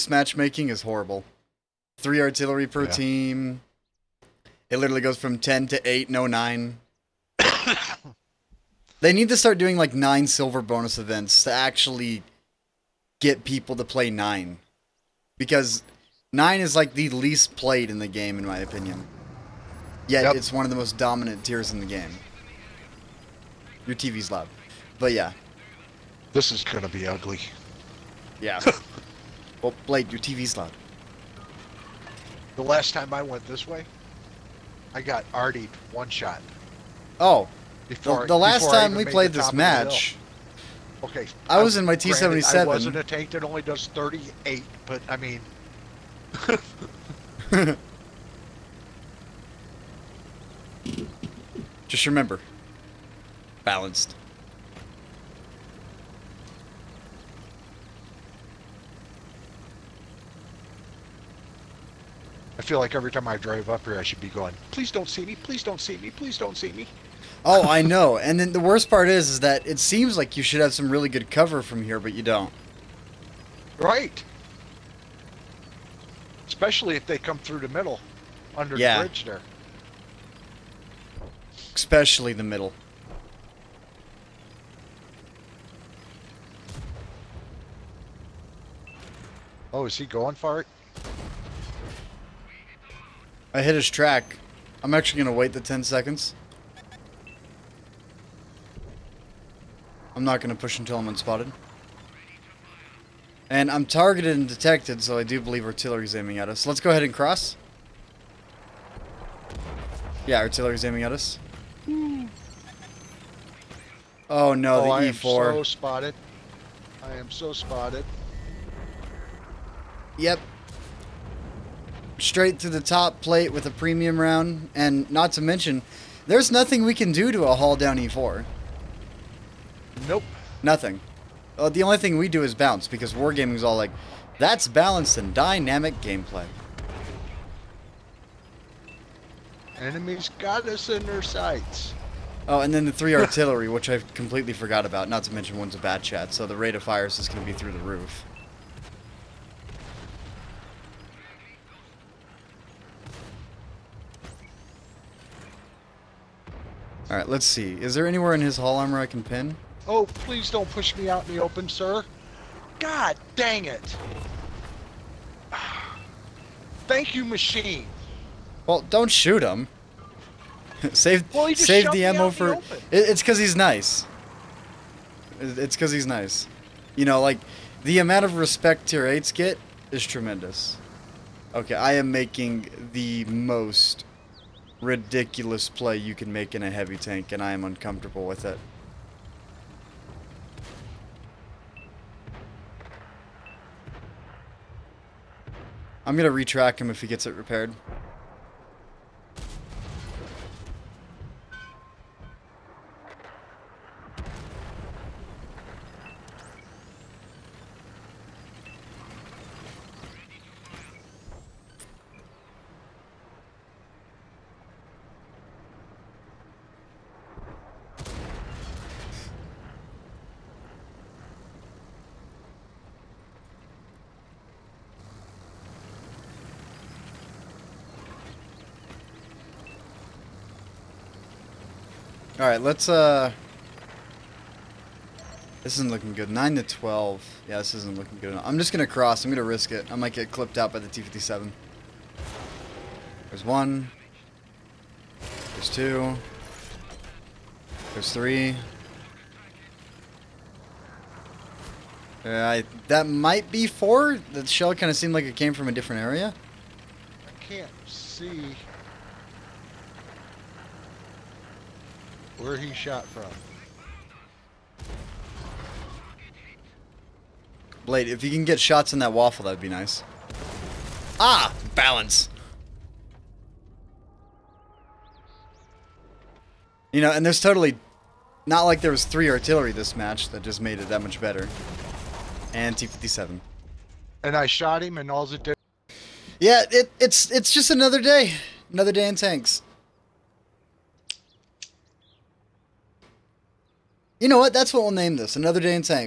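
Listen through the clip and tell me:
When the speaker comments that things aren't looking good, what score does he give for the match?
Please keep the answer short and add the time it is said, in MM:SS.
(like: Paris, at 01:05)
9 to 12, at 03:56.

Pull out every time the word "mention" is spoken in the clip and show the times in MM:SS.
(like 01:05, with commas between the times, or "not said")
02:05, 02:25.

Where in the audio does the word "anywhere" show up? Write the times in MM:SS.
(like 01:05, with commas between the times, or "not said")
02:38.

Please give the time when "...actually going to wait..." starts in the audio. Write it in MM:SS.
01:34.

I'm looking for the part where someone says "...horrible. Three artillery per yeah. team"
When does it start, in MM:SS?
00:00.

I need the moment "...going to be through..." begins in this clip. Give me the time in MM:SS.
02:27.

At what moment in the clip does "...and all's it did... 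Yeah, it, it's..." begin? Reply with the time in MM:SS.
04:44.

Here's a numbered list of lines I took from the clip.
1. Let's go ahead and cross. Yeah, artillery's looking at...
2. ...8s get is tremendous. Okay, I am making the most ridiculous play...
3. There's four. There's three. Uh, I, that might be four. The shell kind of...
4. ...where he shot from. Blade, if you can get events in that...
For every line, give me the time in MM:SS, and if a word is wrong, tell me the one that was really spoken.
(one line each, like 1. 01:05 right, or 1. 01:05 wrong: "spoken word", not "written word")
1. 01:46 wrong: "aiming", not "looking"
2. 02:59 right
3. 04:05 wrong: "two", not "four"
4. 04:22 wrong: "shots", not "events".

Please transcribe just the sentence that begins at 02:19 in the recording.
Enemies got us in their sights.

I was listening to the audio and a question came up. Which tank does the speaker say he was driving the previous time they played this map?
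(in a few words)
T77.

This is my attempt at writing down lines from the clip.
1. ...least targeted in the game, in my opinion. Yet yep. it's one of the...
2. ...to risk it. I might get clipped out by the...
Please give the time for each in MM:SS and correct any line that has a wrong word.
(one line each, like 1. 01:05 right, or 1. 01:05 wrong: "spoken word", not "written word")
1. 00:17 wrong: "played", not "targeted"
2. 03:59 right.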